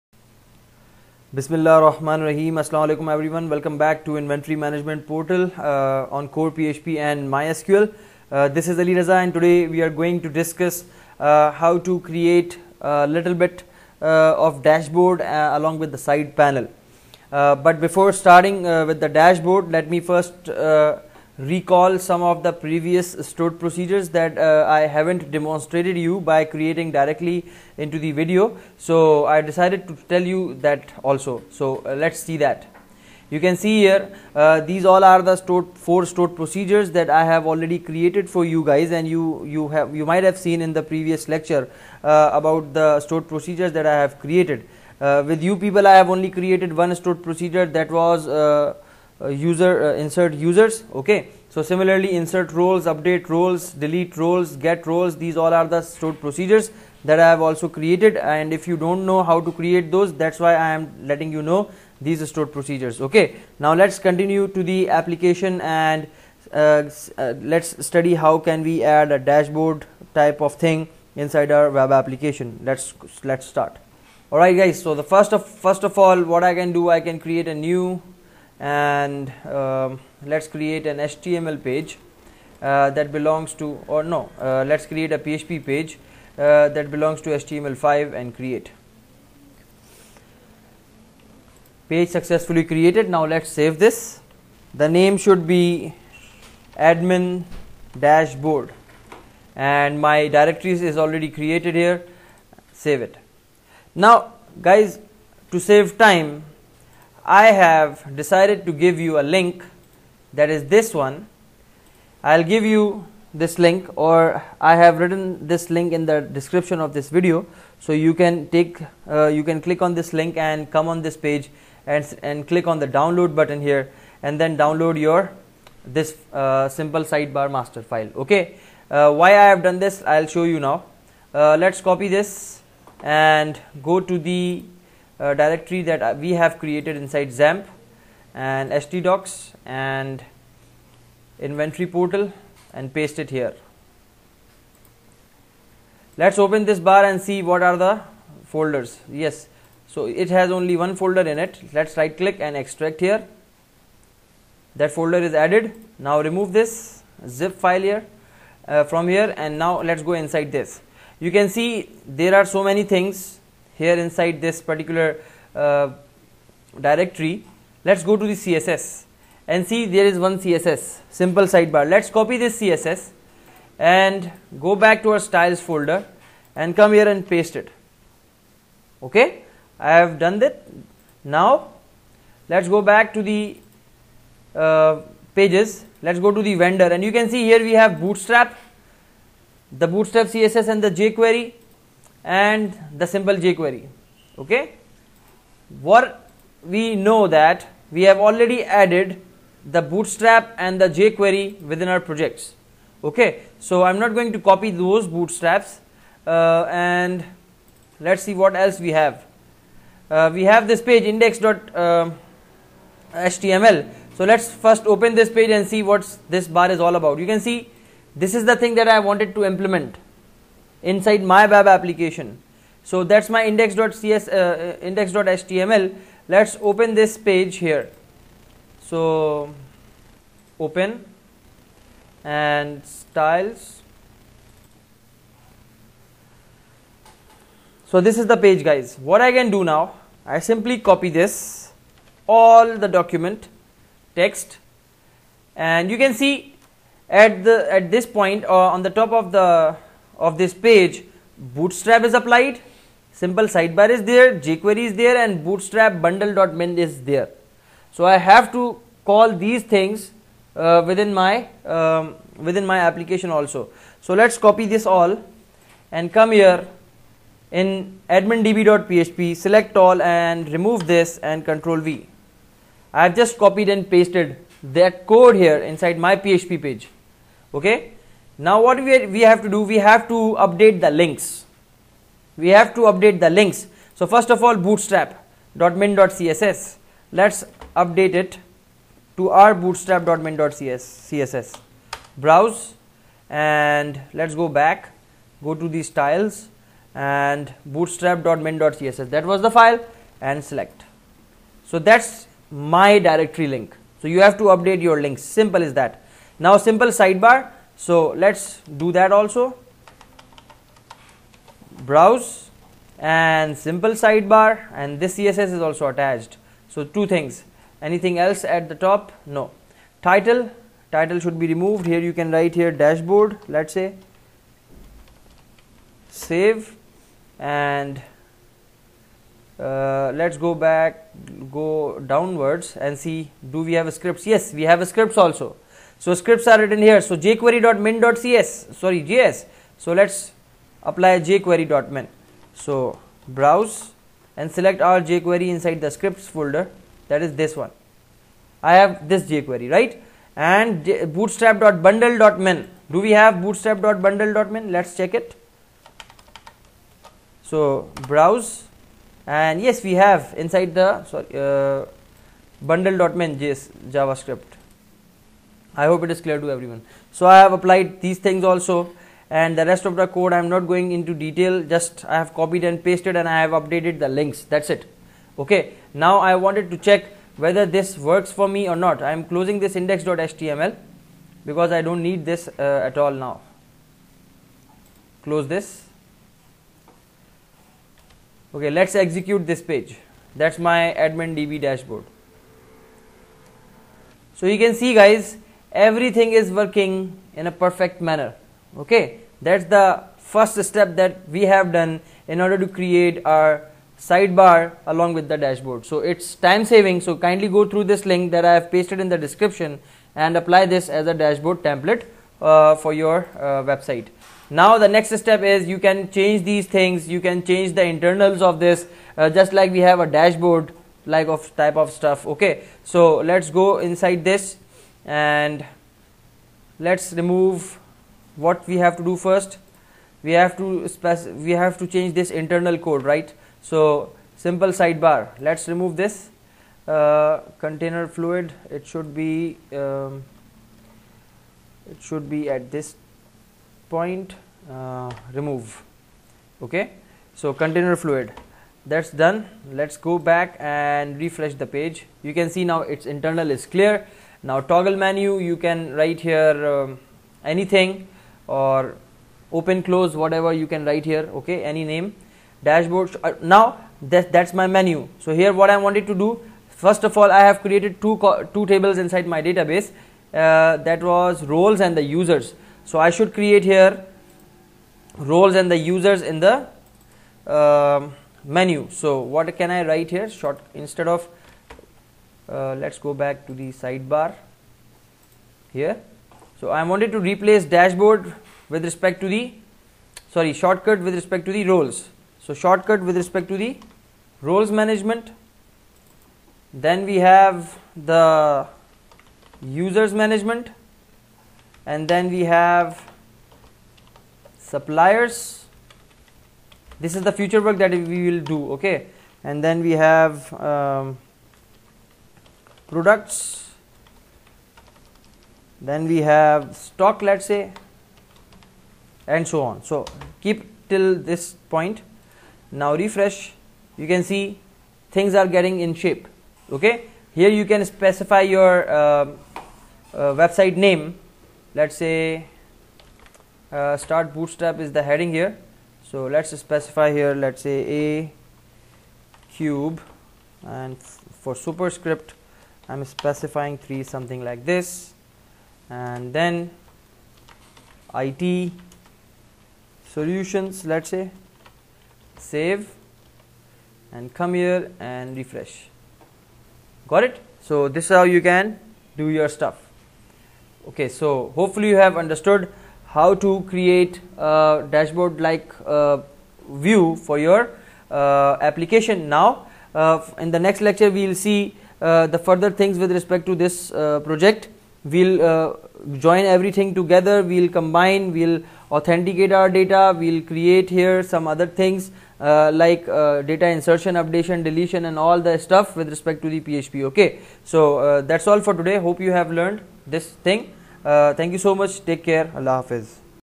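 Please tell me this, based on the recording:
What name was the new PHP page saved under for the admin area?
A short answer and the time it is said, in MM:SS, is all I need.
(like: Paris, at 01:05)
admin dashboard, at 01:36.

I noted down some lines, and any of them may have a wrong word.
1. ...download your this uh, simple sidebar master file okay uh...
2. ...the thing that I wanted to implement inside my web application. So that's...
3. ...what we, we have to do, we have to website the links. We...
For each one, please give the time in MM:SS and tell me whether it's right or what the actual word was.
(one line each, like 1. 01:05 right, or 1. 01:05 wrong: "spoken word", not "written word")
1. 02:04 right
2. 03:38 right
3. 04:38 wrong: "update", not "website".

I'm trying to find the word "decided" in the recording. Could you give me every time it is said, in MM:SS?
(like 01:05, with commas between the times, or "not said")
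00:29, 01:48.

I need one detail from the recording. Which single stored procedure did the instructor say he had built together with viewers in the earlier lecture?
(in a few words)
insert users.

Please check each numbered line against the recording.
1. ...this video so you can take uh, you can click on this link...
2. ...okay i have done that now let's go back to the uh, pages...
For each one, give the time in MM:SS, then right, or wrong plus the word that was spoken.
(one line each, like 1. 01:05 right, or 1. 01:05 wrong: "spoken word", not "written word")
1. 01:56 right
2. 02:59 right.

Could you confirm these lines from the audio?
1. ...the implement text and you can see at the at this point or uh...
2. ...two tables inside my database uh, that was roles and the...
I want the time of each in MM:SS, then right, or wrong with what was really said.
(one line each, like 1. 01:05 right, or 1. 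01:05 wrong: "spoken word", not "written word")
1. 04:02 wrong: "document", not "implement"
2. 07:48 right.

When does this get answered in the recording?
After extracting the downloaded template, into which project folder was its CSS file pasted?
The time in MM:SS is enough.
02:55.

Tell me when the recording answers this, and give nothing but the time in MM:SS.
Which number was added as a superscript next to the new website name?
09:03.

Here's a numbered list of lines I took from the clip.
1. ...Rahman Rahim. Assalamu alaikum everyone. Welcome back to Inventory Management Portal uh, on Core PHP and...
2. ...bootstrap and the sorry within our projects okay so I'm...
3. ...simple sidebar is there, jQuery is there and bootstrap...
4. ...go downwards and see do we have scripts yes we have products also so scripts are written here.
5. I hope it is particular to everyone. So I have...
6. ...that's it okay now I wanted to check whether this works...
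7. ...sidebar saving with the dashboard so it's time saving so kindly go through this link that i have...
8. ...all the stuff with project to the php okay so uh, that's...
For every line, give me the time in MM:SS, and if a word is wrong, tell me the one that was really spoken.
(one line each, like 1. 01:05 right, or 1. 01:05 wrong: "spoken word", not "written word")
1. 00:01 right
2. 03:19 wrong: "jQuery", not "sorry"
3. 04:13 right
4. 05:31 wrong: "scripts", not "products"
5. 06:05 wrong: "clear", not "particular"
6. 06:14 right
7. 06:43 wrong: "along", not "saving"
8. 09:45 wrong: "respect", not "project".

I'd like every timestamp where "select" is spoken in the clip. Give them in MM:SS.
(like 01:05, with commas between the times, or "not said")
04:29, 05:00, 05:44.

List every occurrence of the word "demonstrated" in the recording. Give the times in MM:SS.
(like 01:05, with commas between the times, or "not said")
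00:25.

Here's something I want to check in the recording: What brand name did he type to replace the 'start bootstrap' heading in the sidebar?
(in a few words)
a cube.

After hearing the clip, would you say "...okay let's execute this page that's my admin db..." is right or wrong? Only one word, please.
right.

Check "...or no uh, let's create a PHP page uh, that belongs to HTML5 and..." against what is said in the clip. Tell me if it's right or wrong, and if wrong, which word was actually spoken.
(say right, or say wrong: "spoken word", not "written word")
right.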